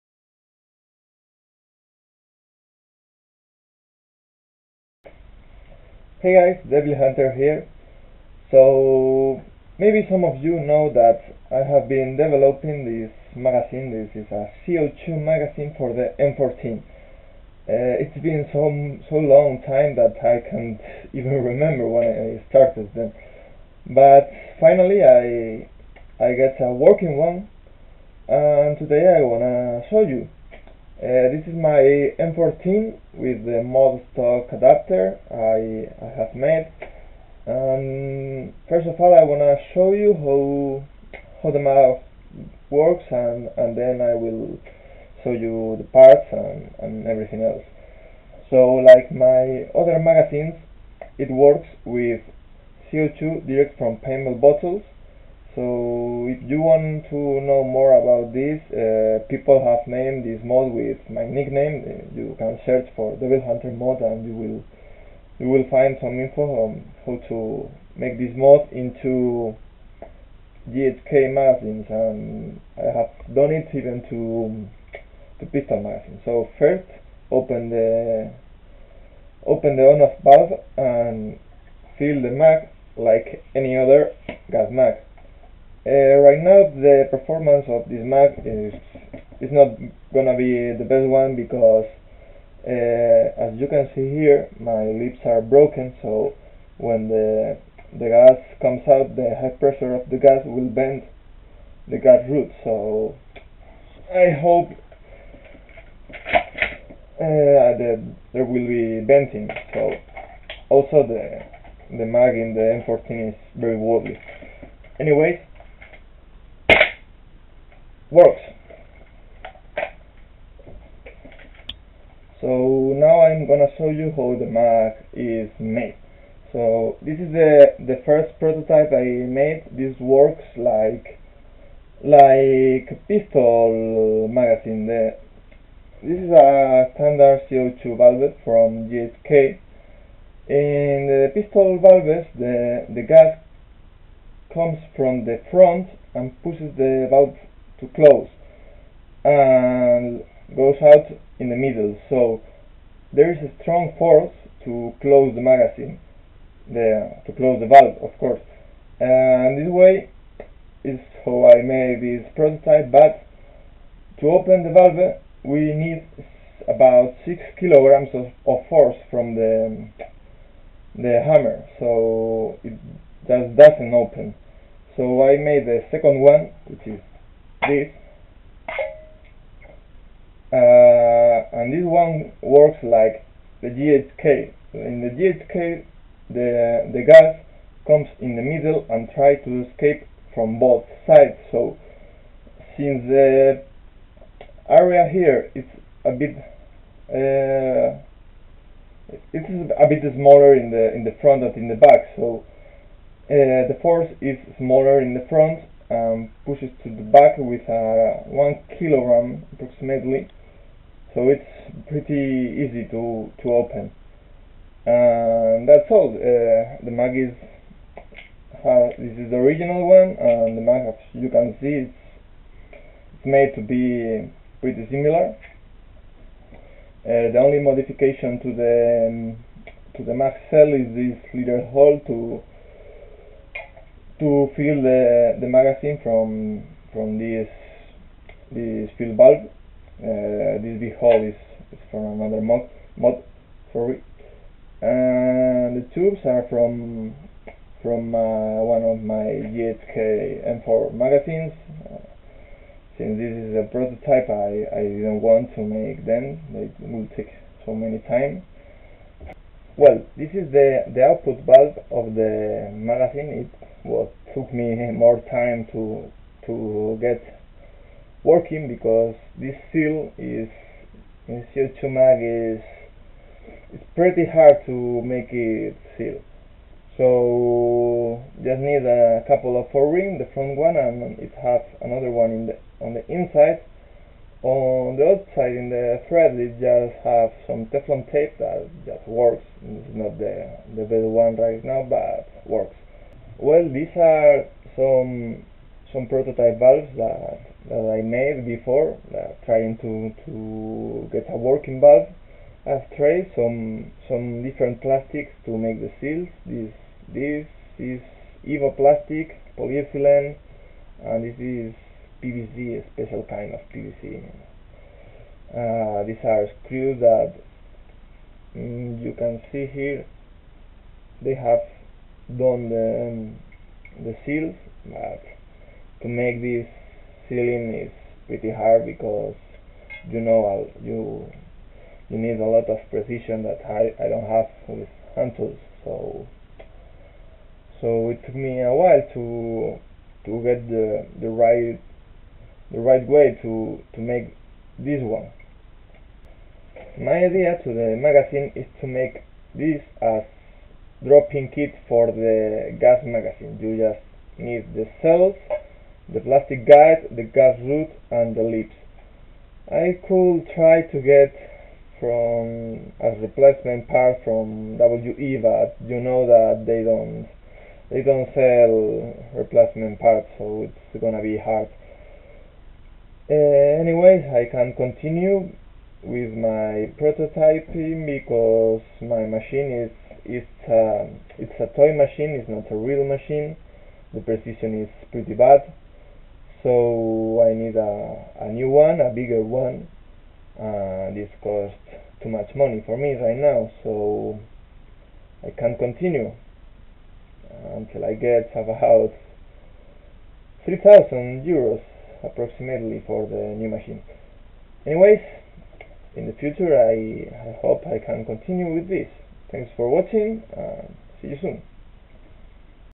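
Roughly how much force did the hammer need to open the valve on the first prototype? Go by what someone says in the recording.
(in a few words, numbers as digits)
6 kilograms.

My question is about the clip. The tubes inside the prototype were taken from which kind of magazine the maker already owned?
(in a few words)
GHK M4 magazines.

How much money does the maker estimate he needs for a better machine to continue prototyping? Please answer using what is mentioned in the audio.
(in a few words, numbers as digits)
3,000 euros.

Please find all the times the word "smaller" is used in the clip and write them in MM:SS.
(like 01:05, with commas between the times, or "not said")
03:20, 03:24.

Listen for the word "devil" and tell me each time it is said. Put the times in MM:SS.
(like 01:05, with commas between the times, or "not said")
00:06, 01:03.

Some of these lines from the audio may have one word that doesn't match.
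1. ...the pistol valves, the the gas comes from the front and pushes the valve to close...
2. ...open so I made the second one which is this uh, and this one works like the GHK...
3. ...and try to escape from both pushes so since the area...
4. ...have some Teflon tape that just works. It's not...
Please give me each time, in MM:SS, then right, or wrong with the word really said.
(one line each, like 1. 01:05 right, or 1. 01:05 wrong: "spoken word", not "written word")
1. 02:21 right
2. 02:53 right
3. 03:08 wrong: "sides", not "pushes"
4. 04:47 right.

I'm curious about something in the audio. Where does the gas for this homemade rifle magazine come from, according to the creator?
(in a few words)
paintball bottles.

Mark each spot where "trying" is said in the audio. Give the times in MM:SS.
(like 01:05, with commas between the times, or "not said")
04:59.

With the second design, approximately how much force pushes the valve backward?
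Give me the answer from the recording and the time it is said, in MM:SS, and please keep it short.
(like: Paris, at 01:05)
1 kilogram, at 03:28.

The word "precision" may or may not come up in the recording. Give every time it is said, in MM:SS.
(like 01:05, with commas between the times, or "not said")
05:32, 06:24.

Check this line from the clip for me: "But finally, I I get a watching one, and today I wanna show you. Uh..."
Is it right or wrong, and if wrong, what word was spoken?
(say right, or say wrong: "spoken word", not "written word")
wrong: "working", not "watching".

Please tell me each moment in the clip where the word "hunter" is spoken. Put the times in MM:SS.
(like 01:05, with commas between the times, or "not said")
00:07, 01:03.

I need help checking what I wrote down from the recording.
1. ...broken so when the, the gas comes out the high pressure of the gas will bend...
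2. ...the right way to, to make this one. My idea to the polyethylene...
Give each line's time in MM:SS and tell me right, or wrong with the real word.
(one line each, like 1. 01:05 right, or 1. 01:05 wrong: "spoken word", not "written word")
1. 01:35 right
2. 05:42 wrong: "magazine", not "polyethylene".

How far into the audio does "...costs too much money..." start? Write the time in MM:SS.
06:31.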